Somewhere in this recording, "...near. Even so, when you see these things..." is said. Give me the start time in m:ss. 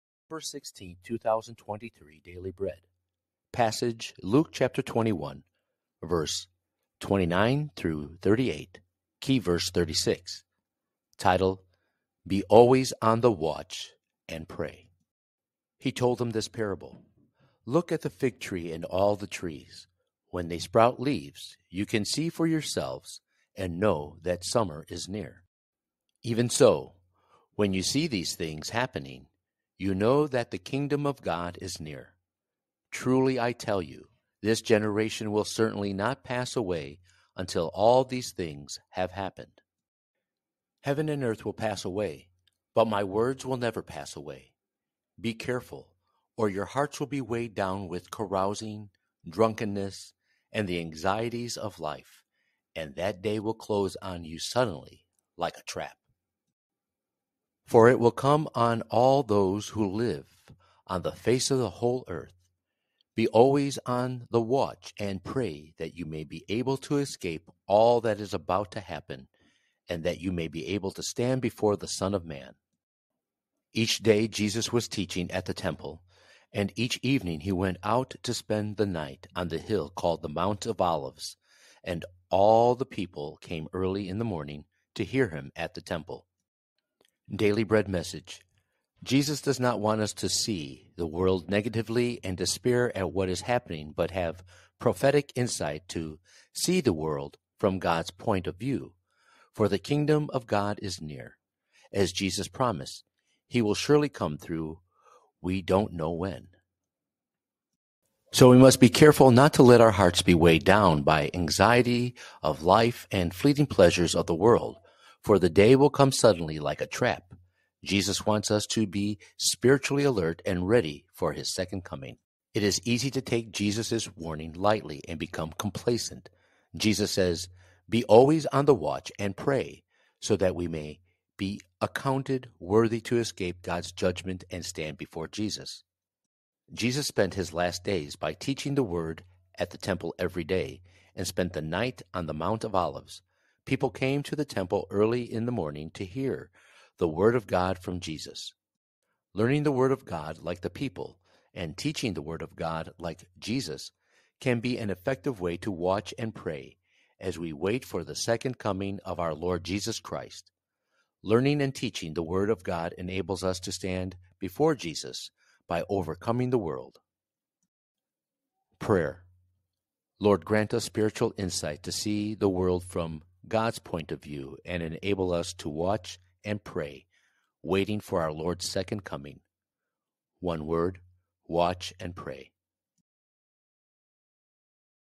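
0:25.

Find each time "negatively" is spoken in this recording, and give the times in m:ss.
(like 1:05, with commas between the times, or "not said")
1:31.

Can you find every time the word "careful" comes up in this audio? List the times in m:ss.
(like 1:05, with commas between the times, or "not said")
0:45, 1:48.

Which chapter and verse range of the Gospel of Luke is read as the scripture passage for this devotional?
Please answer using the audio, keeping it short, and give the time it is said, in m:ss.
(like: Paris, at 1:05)
Luke 21:29-38, at 0:04.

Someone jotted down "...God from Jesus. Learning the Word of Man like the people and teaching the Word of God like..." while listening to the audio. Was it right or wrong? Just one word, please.
wrong.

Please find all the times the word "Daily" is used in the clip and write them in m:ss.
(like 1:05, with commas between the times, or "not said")
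0:02, 1:27.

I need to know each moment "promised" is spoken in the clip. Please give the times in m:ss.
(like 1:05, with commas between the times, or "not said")
1:42.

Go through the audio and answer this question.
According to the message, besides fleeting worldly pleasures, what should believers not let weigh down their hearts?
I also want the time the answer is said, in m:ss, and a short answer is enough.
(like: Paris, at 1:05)
Anxiety of life, at 1:51.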